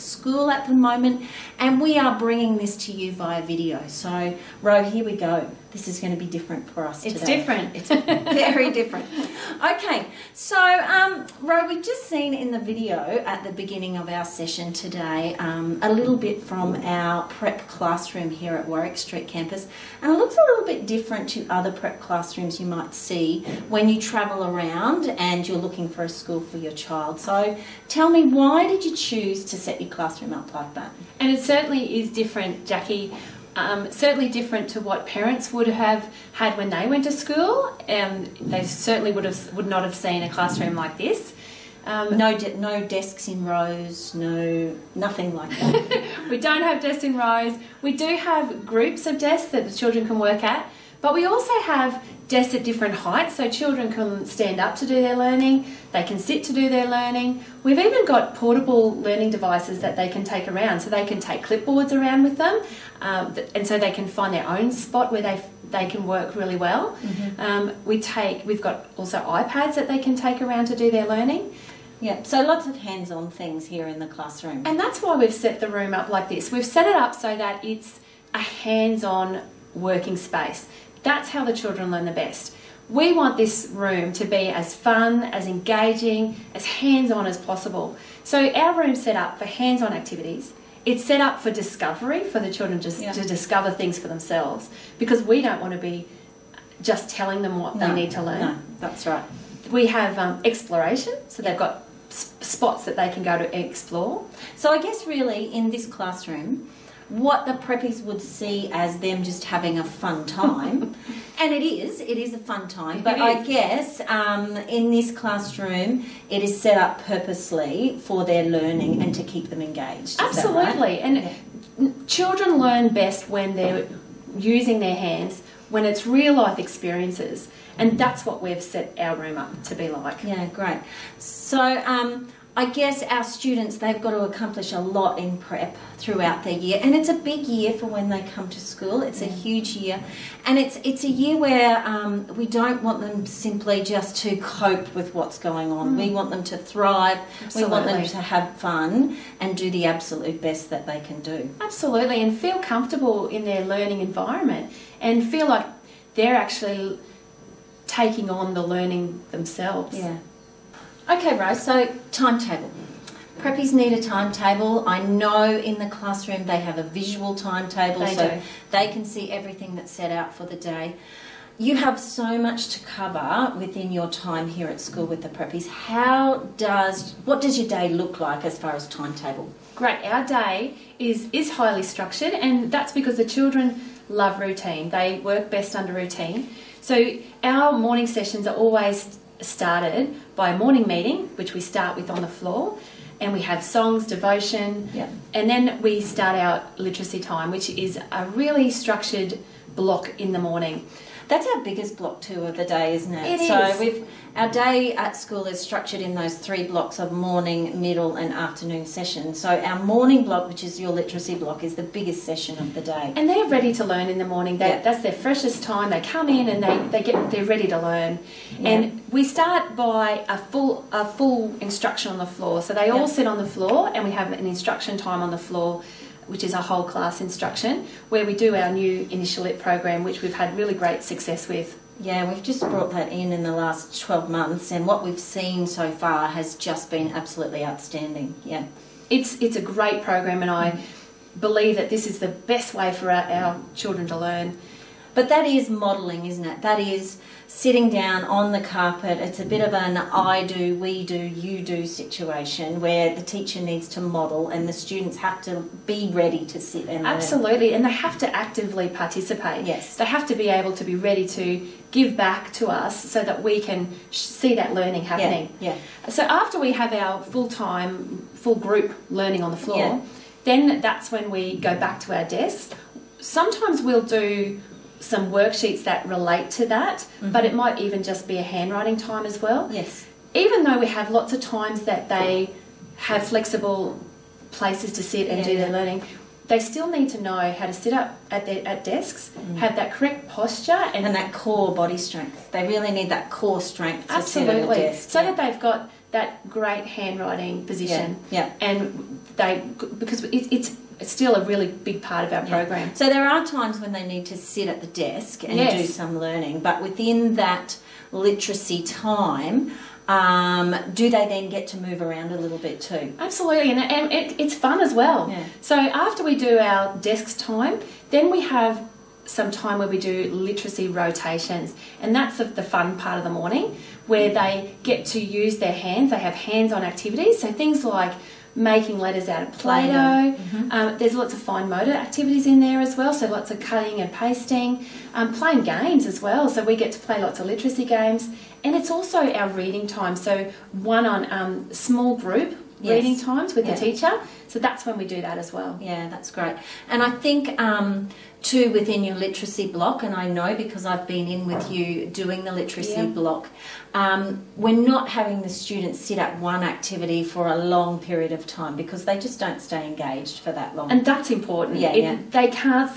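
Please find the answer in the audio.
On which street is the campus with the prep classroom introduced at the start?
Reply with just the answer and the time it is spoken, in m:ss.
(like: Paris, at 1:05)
Warwick Street, at 0:18.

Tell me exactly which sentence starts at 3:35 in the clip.
They come in and they, they get they're ready to learn.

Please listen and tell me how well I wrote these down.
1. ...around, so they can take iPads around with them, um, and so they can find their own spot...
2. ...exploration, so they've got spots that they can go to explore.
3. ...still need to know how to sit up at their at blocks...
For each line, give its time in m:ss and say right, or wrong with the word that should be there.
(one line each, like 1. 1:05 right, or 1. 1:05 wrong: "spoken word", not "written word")
1. 1:00 wrong: "clipboards", not "iPads"
2. 1:40 right
3. 4:46 wrong: "desks", not "blocks".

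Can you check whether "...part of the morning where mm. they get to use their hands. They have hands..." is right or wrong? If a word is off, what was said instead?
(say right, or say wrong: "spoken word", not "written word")
right.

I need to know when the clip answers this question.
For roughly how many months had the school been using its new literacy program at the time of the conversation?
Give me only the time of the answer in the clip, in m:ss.
3:53.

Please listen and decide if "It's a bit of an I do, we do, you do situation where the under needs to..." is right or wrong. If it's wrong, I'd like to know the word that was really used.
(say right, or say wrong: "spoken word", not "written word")
wrong: "teacher", not "under".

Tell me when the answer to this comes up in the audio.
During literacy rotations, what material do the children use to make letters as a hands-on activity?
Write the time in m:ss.
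5:29.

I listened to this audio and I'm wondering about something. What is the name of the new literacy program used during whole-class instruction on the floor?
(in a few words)
InitiaLit.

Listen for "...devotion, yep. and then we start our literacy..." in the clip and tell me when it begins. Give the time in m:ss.
3:14.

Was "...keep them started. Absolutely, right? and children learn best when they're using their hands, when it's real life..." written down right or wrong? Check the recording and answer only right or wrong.
wrong.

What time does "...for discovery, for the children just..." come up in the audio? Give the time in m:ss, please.
1:31.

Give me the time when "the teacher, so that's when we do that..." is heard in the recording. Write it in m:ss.
5:43.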